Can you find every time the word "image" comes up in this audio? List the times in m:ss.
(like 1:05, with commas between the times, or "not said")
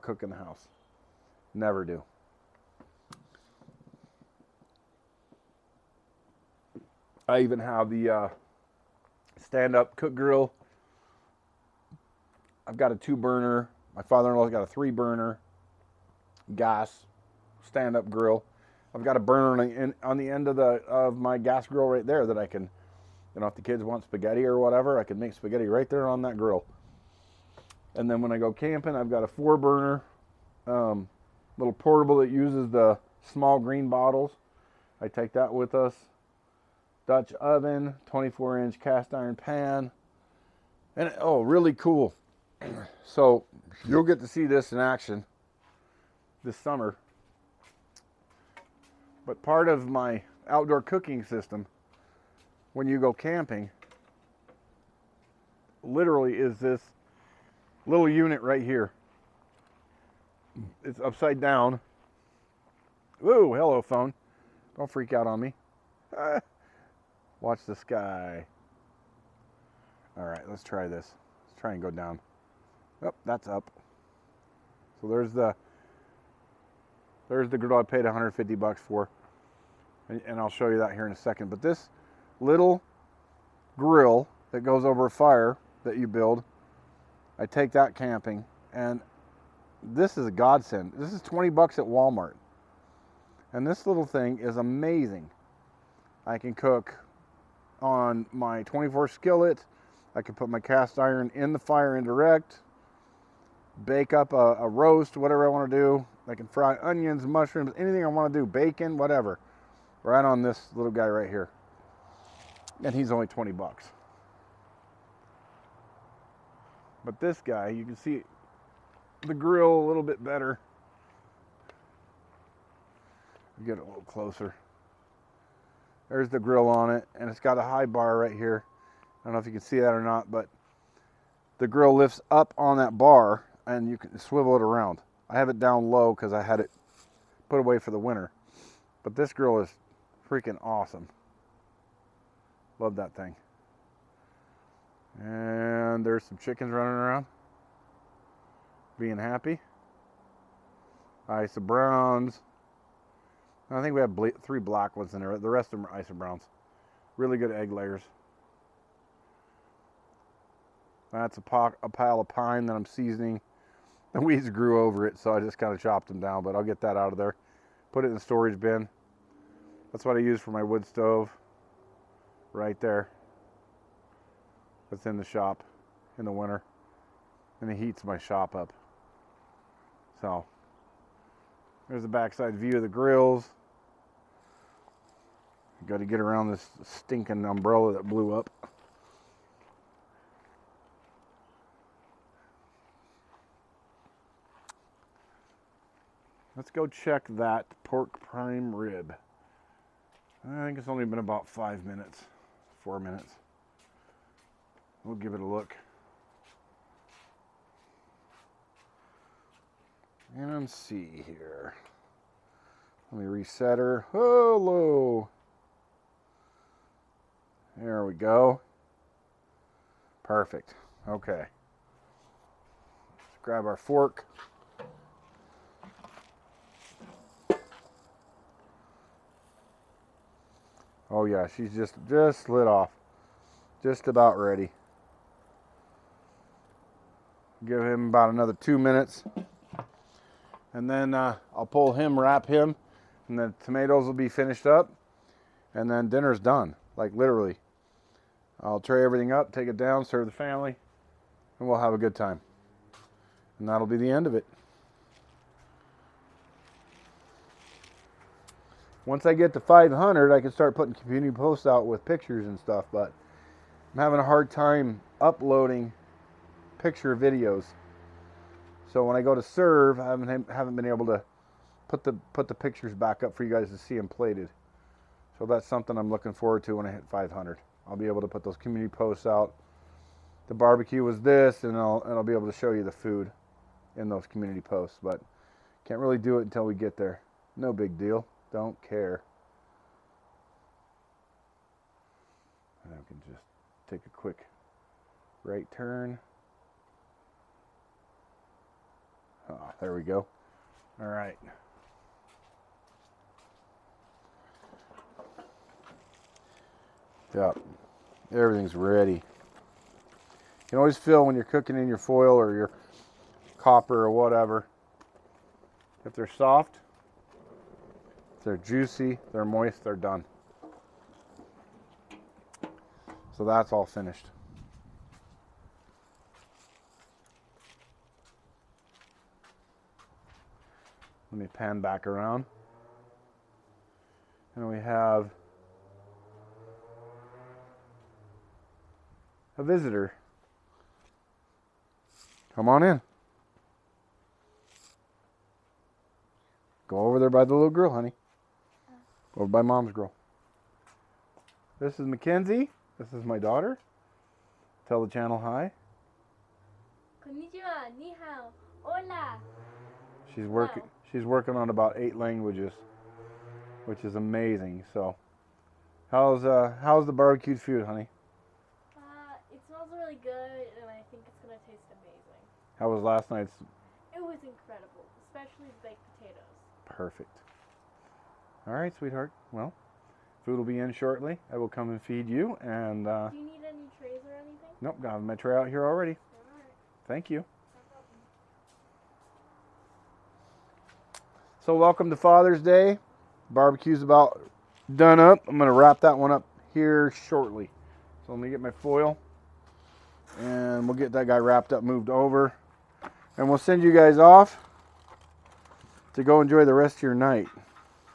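not said.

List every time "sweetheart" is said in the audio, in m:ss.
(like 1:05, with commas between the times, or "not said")
6:18.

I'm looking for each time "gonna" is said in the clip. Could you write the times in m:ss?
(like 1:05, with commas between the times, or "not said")
6:11, 6:35.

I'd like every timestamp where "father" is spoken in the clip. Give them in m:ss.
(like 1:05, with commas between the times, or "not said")
0:14, 6:32.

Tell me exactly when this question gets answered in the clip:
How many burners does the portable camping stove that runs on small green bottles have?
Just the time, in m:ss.
0:29.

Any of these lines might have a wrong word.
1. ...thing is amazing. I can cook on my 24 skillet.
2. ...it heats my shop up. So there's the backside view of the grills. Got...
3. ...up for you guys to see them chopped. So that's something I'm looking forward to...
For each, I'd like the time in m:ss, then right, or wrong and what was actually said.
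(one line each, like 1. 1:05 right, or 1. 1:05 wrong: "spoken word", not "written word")
1. 1:34 right
2. 2:57 right
3. 4:33 wrong: "plated", not "chopped".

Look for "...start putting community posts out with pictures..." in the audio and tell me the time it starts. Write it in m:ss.
4:20.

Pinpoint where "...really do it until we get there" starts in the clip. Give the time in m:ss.
4:45.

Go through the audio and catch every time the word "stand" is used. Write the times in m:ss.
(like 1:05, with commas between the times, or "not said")
0:09, 0:17.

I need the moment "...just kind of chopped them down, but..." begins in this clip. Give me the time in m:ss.
2:45.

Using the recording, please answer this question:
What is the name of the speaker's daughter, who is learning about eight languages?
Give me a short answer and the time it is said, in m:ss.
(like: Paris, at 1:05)
Mackenzie, at 5:52.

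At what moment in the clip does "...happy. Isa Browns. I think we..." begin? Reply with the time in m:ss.
2:29.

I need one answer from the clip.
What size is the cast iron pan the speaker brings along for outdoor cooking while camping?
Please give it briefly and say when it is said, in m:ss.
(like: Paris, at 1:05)
24 inch, at 0:38.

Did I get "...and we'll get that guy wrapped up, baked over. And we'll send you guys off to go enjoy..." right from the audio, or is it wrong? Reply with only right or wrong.
wrong.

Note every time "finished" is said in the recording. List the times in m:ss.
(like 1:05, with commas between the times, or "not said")
4:04, 5:23.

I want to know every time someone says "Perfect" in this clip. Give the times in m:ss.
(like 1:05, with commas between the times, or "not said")
3:40, 6:16.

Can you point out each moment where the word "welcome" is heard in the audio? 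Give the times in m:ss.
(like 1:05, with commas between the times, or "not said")
6:31.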